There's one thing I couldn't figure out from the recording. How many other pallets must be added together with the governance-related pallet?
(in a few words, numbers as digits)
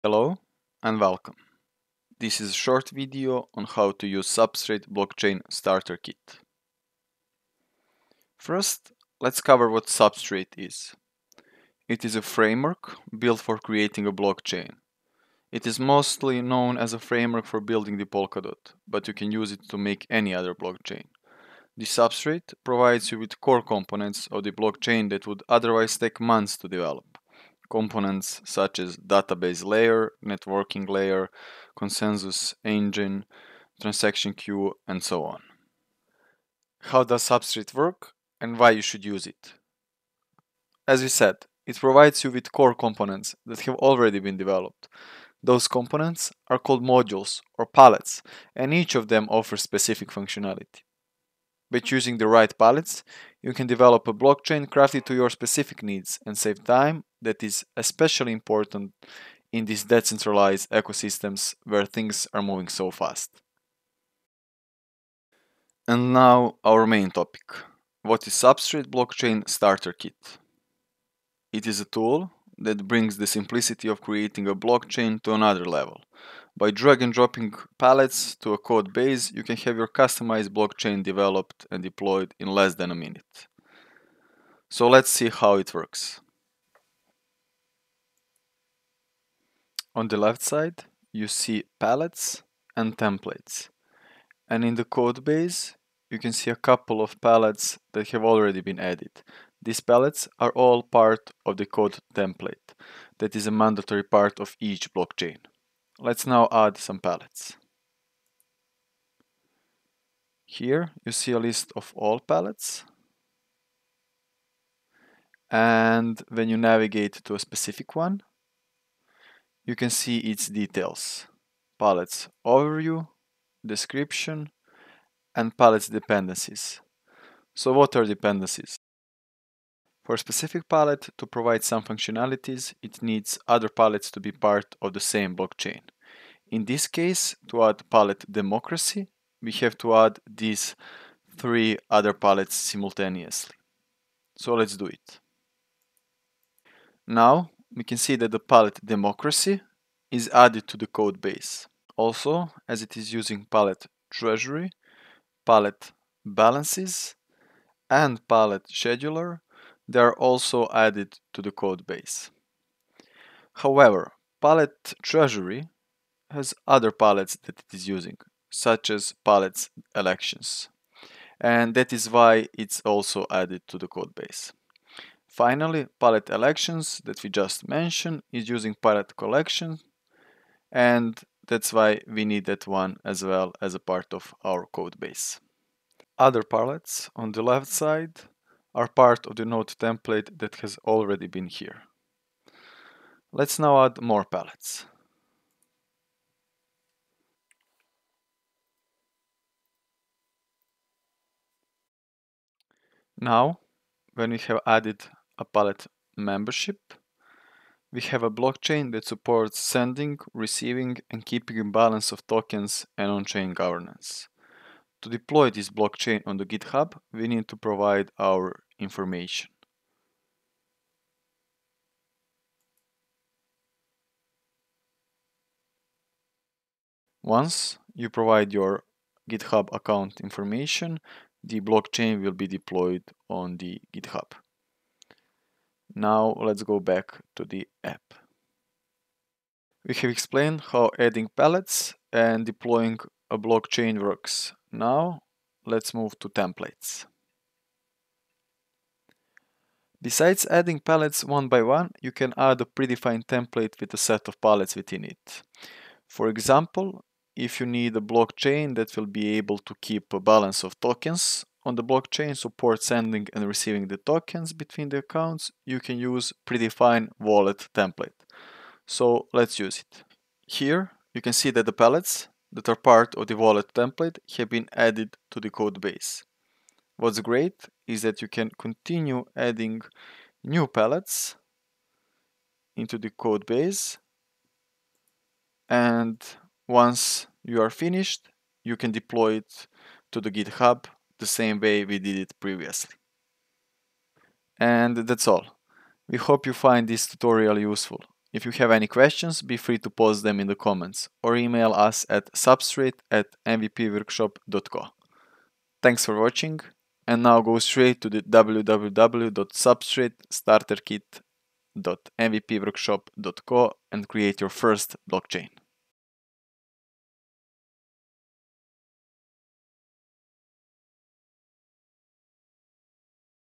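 3.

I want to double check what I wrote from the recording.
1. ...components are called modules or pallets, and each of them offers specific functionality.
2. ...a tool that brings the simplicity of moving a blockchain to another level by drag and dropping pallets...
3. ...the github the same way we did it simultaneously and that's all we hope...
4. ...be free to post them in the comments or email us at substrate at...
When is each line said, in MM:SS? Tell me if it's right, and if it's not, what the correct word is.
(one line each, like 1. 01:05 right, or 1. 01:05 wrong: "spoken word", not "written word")
1. 00:45 right
2. 01:11 wrong: "creating", not "moving"
3. 04:50 wrong: "previously", not "simultaneously"
4. 04:59 right.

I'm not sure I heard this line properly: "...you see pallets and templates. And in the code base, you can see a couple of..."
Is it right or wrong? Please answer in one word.
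right.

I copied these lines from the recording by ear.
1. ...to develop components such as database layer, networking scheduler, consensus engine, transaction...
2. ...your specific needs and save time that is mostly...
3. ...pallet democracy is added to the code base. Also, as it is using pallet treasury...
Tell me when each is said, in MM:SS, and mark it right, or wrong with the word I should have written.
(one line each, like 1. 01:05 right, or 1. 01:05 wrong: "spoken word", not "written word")
1. 00:26 wrong: "layer", not "scheduler"
2. 00:55 wrong: "especially", not "mostly"
3. 02:28 right.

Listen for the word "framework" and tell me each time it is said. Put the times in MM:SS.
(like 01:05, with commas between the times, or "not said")
00:12, 00:16.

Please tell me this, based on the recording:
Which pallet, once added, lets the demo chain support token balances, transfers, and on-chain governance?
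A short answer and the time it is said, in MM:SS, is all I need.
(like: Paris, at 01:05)
pallet membership, at 03:25.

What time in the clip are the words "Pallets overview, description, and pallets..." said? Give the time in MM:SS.
02:01.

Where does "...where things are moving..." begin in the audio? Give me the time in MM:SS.
01:01.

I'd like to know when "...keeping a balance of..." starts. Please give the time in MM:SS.
03:31.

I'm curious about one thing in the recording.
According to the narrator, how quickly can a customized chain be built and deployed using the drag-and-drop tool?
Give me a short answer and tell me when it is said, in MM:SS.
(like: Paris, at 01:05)
less than a minute, at 01:22.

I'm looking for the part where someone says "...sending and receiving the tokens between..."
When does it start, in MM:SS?
04:22.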